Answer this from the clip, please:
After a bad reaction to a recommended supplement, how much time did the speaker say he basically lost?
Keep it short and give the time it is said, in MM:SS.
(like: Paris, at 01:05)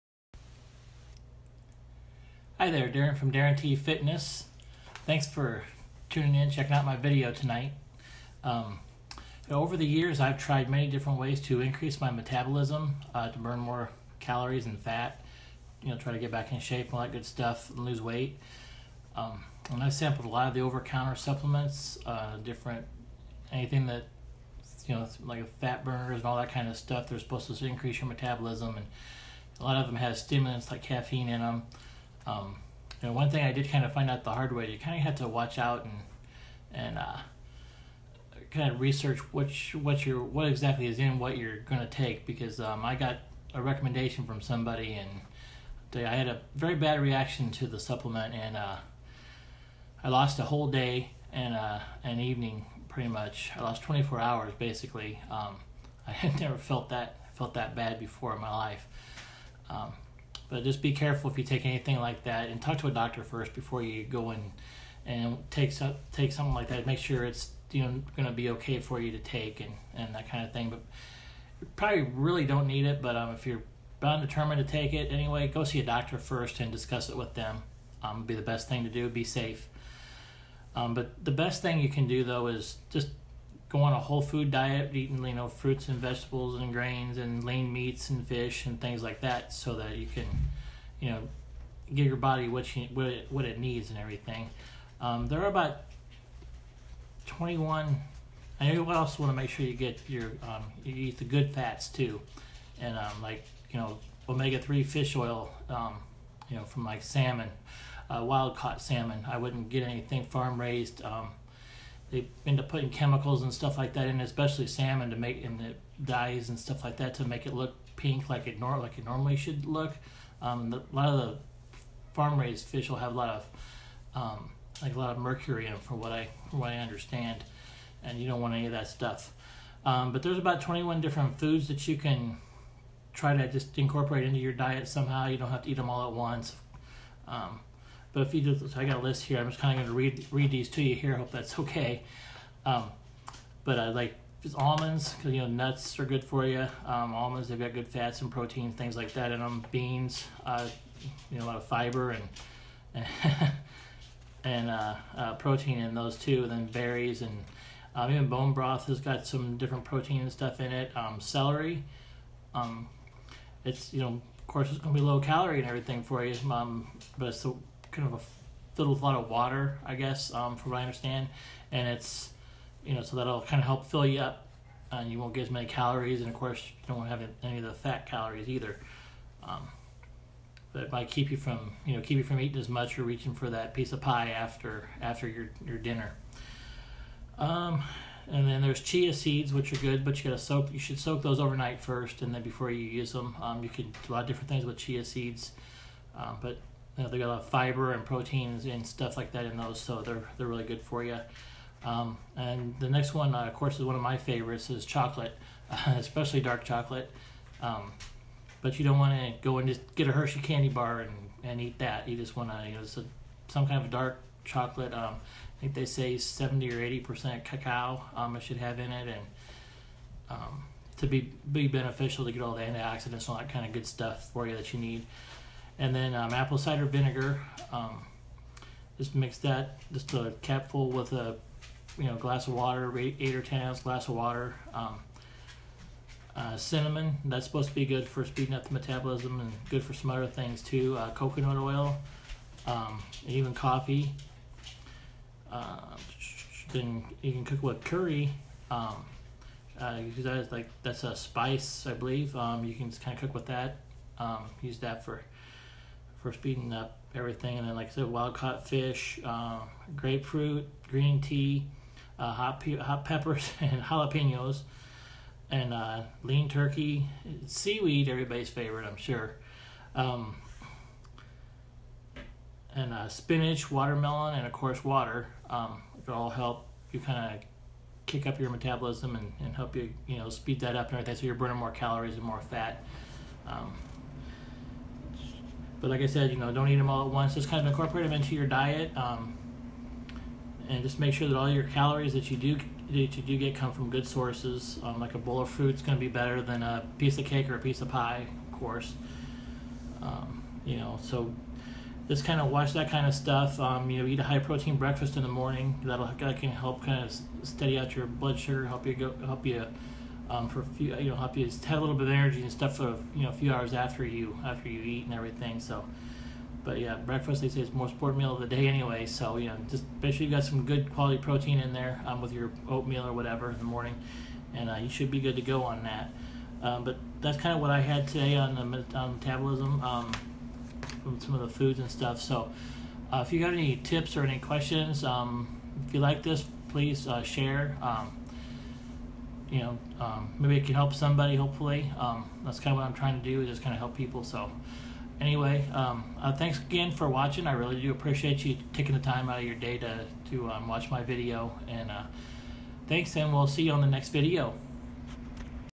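24 hours, at 00:53.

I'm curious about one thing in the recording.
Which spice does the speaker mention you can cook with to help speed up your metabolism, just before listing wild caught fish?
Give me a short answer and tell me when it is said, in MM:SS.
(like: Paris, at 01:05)
Curry, at 04:07.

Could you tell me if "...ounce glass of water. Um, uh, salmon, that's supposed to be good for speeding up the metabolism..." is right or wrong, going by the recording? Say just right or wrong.
wrong.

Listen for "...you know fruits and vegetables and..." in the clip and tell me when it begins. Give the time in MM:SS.
01:25.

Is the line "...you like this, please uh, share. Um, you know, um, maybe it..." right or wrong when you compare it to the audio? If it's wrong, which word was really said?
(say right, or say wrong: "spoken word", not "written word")
right.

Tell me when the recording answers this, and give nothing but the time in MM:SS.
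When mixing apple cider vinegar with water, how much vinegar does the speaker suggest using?
03:50.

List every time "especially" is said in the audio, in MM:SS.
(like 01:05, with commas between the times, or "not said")
01:54, 03:25.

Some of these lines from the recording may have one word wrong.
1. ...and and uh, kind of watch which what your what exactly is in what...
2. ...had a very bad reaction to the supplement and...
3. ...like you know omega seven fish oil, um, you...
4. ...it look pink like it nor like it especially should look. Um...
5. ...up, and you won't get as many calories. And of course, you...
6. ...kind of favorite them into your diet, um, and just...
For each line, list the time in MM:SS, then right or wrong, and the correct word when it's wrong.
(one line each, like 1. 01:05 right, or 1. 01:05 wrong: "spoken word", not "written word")
1. 00:35 wrong: "research", not "watch"
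2. 00:46 right
3. 01:43 wrong: "three", not "seven"
4. 01:57 wrong: "normally", not "especially"
5. 02:54 right
6. 04:47 wrong: "incorporate", not "favorite".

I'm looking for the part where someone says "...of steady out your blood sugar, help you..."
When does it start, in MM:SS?
05:07.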